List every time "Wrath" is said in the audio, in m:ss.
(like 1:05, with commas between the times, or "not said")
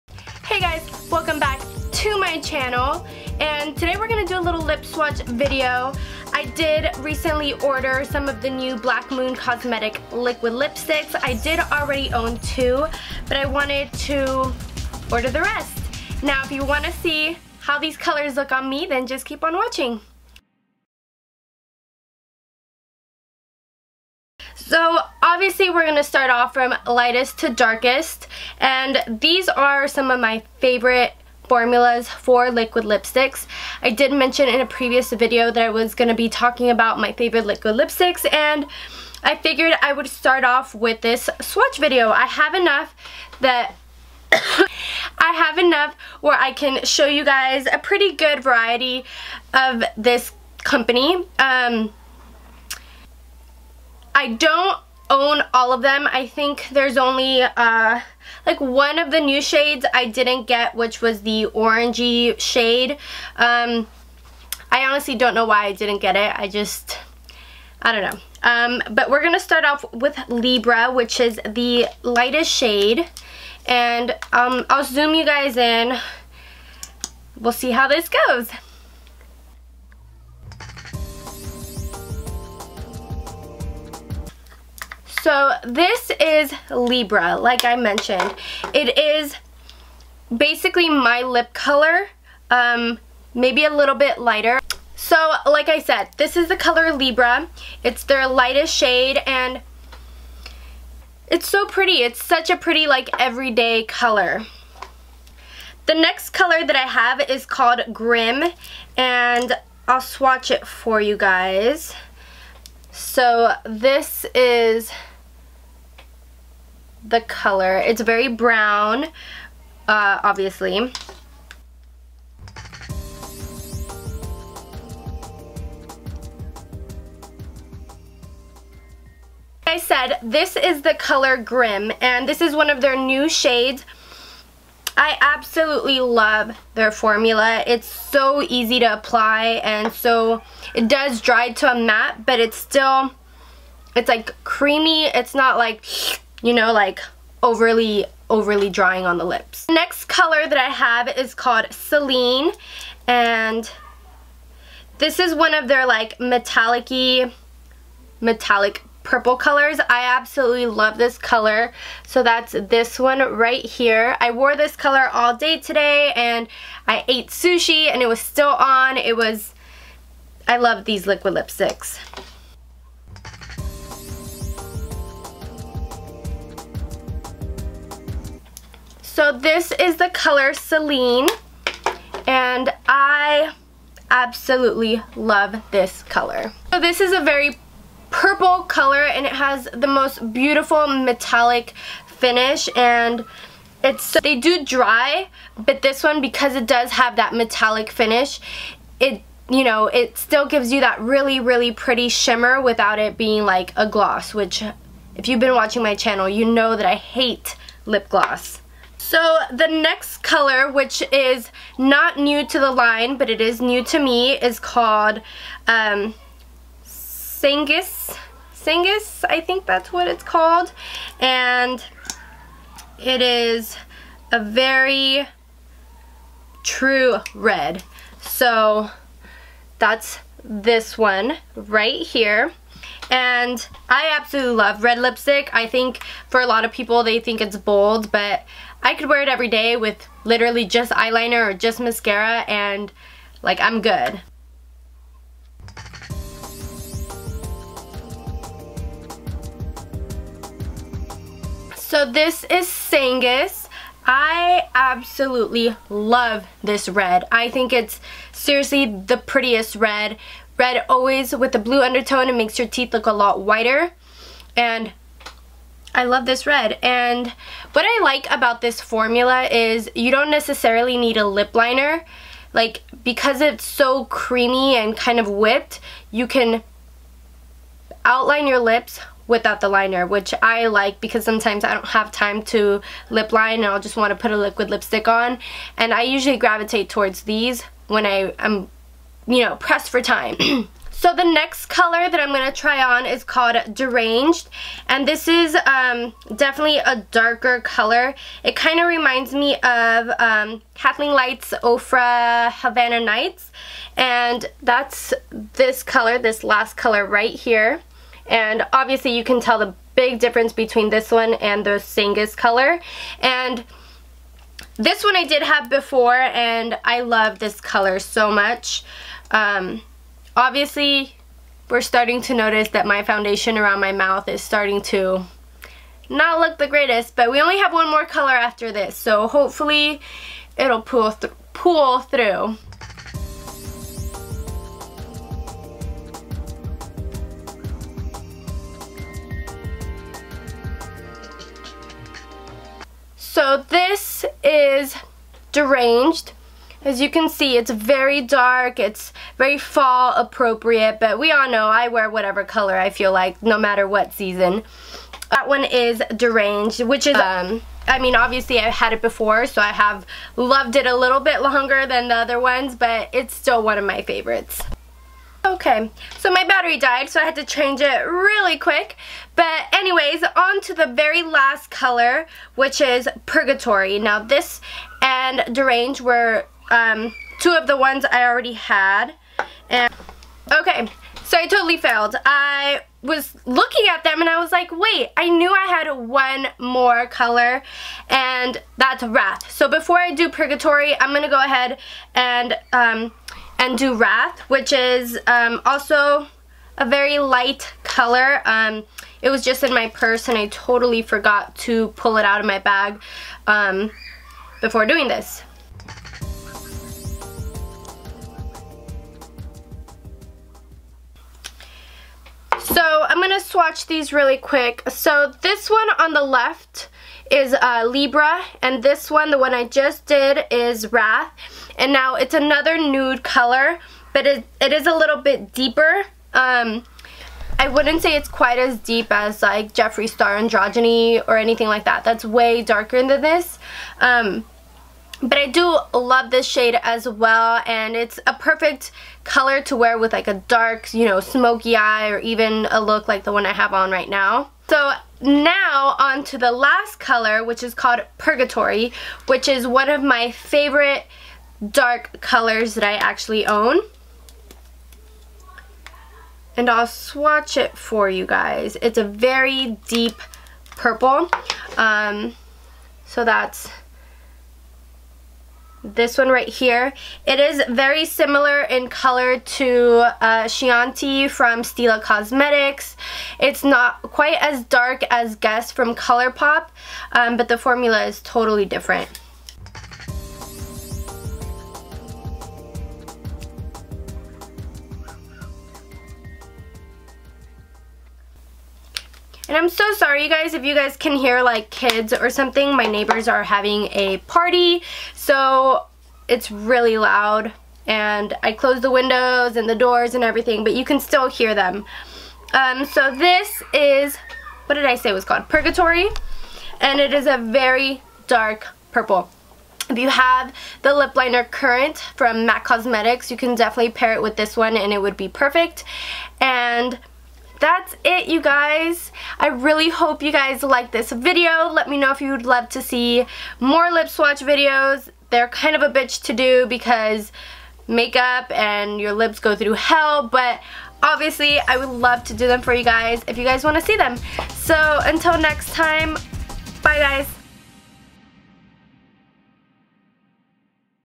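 6:29, 6:33, 7:00.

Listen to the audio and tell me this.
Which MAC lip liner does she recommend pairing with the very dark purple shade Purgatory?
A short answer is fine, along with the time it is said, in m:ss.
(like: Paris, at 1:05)
Currant, at 8:31.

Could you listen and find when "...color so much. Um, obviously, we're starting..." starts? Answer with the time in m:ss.
5:17.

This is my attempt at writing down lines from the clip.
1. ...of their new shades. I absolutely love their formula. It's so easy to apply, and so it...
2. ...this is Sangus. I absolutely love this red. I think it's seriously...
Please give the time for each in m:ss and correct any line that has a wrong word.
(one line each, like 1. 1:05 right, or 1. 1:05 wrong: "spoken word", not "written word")
1. 2:12 right
2. 4:12 right.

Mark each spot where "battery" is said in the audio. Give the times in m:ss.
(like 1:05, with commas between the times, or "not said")
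6:06.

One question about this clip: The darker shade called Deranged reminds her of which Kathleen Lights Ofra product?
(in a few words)
Havana Nights.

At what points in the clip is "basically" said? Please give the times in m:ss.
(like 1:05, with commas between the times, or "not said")
1:30.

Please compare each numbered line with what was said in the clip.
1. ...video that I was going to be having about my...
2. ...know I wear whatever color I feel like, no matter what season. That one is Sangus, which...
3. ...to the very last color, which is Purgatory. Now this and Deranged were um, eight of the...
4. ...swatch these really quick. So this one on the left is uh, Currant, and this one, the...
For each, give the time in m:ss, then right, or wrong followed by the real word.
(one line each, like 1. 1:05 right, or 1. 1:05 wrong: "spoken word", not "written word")
1. 0:35 wrong: "talking", not "having"
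2. 5:51 wrong: "Deranged", not "Sangus"
3. 6:10 wrong: "two", not "eight"
4. 6:53 wrong: "Libra", not "Currant".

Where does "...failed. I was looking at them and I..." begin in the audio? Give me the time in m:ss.
6:21.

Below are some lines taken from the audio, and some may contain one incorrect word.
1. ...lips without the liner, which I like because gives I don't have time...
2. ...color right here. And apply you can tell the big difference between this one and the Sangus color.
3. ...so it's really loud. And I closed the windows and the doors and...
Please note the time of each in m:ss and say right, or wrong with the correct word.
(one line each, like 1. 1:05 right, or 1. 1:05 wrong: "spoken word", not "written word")
1. 4:38 wrong: "sometimes", not "gives"
2. 5:06 wrong: "obviously", not "apply"
3. 8:15 right.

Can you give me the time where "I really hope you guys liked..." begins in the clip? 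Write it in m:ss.
8:39.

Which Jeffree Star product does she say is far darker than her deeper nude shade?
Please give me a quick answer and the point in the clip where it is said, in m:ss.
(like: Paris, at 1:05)
Androgyny, at 7:10.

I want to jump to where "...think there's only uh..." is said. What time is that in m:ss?
0:56.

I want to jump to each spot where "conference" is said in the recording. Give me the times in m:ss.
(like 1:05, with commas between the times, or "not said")
not said.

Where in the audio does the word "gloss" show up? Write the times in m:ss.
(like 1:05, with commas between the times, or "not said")
3:23, 3:28.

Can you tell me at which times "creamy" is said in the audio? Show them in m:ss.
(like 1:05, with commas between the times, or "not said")
2:24, 4:34.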